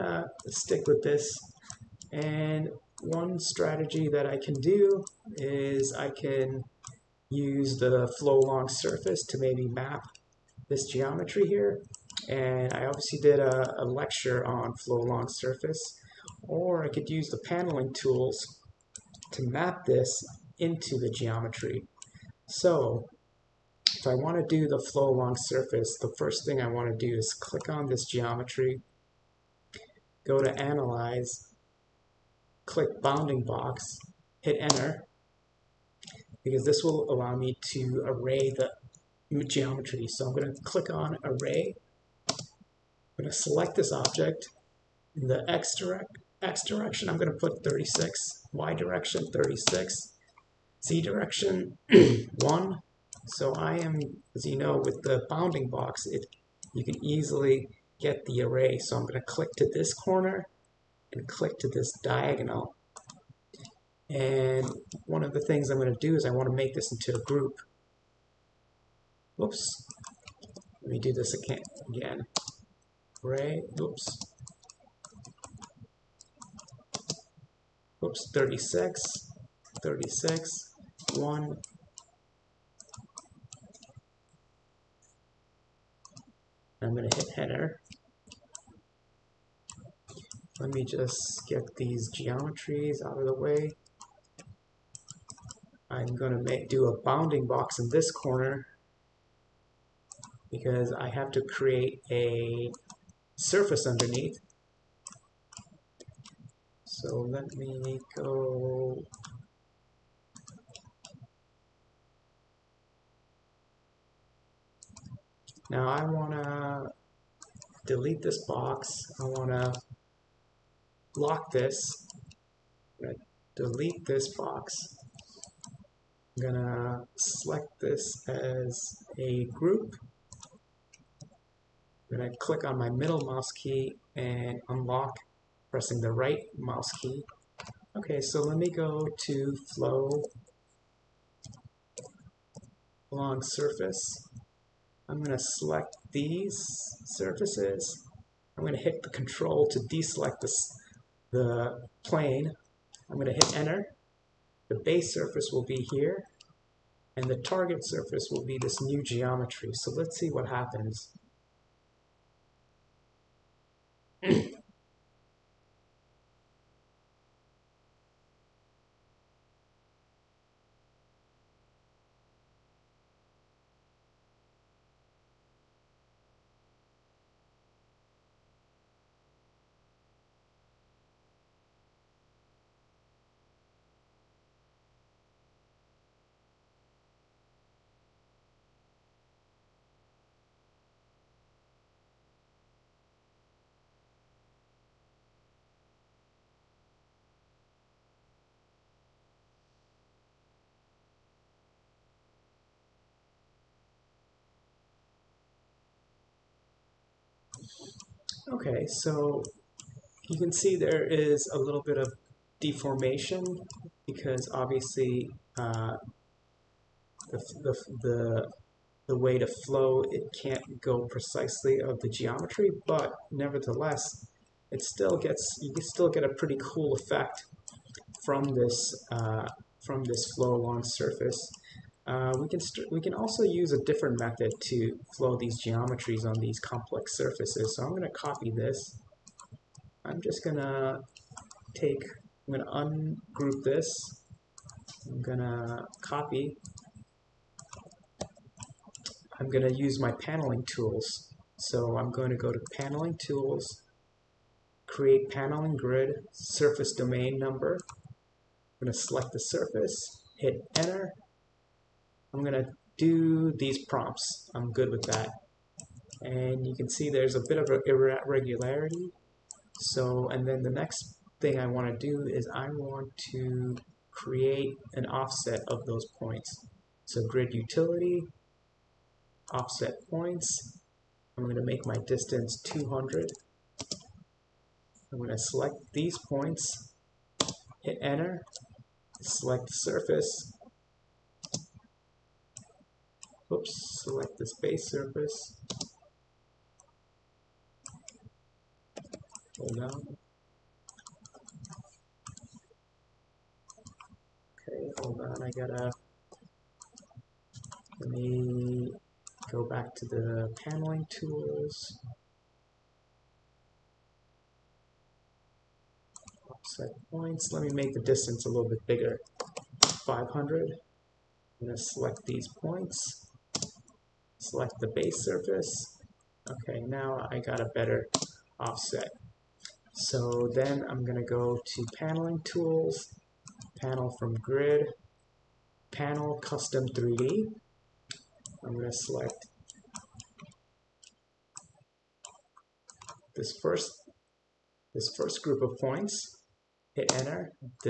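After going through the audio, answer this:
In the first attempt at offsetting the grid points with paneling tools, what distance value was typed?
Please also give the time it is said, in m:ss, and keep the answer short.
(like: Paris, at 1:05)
200, at 4:42.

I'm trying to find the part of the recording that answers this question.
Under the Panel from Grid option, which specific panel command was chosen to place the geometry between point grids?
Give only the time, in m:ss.
5:35.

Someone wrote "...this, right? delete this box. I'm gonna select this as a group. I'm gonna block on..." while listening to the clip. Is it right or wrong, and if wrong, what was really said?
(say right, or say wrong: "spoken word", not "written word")
wrong: "click", not "block".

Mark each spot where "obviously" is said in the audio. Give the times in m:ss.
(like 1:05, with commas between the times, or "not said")
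0:12, 3:34.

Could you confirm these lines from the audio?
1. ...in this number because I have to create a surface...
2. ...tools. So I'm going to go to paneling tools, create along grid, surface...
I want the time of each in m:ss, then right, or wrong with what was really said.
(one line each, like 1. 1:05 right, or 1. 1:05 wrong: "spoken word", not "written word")
1. 1:37 wrong: "corner", not "number"
2. 4:10 wrong: "paneling", not "along".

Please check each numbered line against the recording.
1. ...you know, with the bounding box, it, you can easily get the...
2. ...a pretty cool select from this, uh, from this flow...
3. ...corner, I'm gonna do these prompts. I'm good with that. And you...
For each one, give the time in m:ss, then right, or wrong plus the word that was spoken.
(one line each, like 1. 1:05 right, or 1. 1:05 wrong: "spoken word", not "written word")
1. 0:54 right
2. 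3:46 wrong: "effect", not "select"
3. 4:20 wrong: "enter", not "corner".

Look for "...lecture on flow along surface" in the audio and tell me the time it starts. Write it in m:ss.
0:13.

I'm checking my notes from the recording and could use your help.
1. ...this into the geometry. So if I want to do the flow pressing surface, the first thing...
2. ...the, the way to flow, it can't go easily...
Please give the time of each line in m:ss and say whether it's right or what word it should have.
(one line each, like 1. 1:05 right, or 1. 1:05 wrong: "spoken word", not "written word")
1. 0:19 wrong: "along", not "pressing"
2. 3:38 wrong: "precisely", not "easily".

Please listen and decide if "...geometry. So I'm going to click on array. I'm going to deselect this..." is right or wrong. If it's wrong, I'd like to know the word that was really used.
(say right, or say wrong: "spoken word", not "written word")
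wrong: "select", not "deselect".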